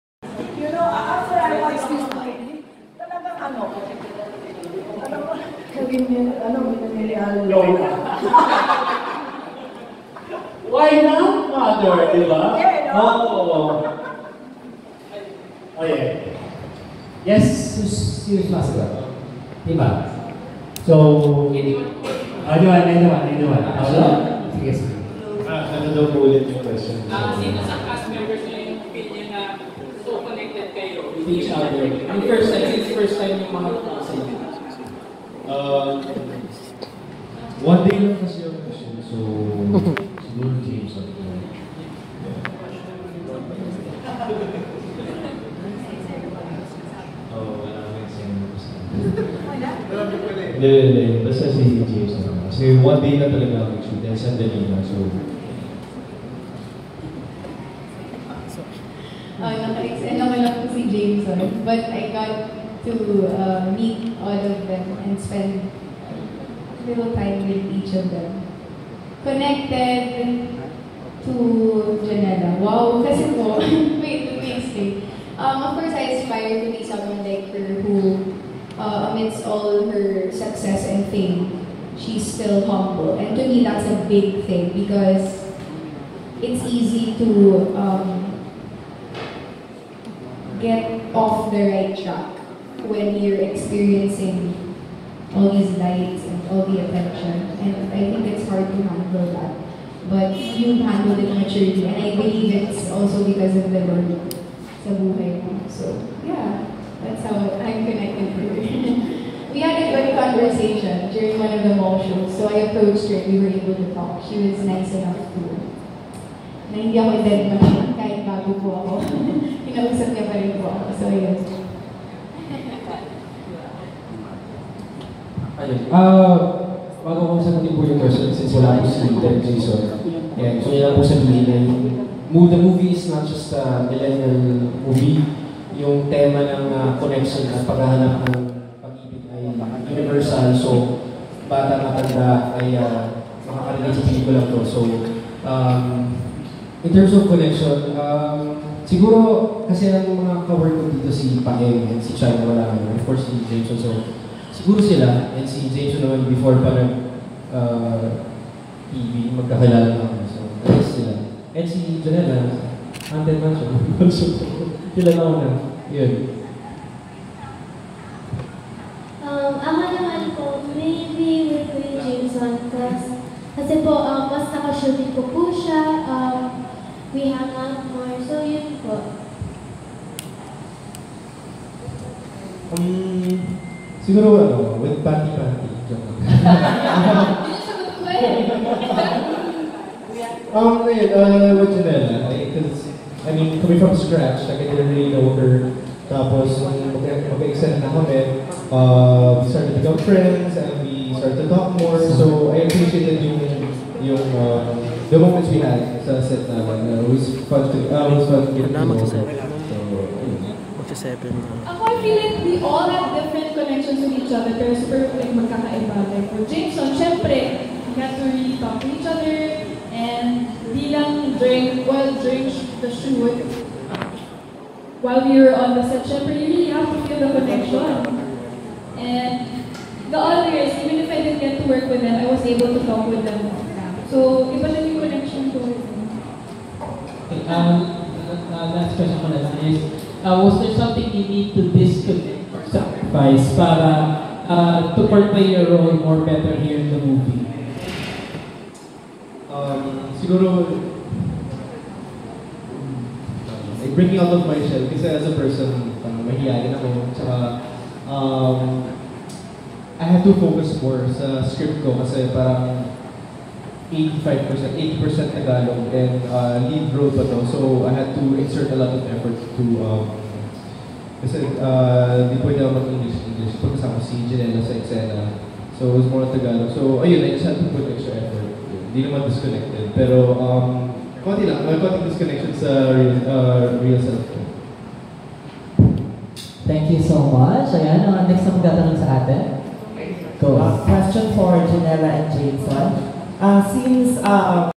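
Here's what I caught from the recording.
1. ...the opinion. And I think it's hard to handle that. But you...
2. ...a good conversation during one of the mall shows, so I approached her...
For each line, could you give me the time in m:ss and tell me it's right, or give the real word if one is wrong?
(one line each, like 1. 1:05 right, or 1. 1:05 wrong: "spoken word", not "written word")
1. 1:36 wrong: "attention", not "opinion"
2. 1:49 right.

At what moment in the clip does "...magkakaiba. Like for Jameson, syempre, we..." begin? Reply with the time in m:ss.
3:35.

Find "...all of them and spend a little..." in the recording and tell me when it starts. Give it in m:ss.
1:04.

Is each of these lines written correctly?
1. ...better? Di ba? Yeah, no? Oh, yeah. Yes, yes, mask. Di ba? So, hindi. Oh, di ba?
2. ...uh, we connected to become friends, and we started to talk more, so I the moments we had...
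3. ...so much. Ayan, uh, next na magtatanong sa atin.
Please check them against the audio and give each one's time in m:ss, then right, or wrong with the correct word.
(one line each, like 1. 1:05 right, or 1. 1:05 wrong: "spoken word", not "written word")
1. 0:11 wrong: "mother", not "better"
2. 3:18 wrong: "started", not "connected"
3. 4:47 right.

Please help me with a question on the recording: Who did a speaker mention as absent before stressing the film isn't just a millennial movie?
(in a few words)
Ted Jason.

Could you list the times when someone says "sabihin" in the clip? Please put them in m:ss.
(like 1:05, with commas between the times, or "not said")
0:05, 2:11.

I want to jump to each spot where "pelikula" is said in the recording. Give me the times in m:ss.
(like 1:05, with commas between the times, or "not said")
2:24.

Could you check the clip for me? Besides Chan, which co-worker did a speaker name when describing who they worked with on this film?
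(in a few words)
Paeng.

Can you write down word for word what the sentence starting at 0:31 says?
Yung first time, since first time yung mga ko Uh, one day lang kasi ako kasi, so siguro James ako.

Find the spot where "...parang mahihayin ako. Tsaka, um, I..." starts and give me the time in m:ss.
4:15.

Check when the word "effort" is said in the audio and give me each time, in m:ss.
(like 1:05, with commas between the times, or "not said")
4:29, 4:38.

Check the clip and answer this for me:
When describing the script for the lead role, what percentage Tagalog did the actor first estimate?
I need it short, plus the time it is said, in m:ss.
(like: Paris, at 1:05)
85%, at 4:23.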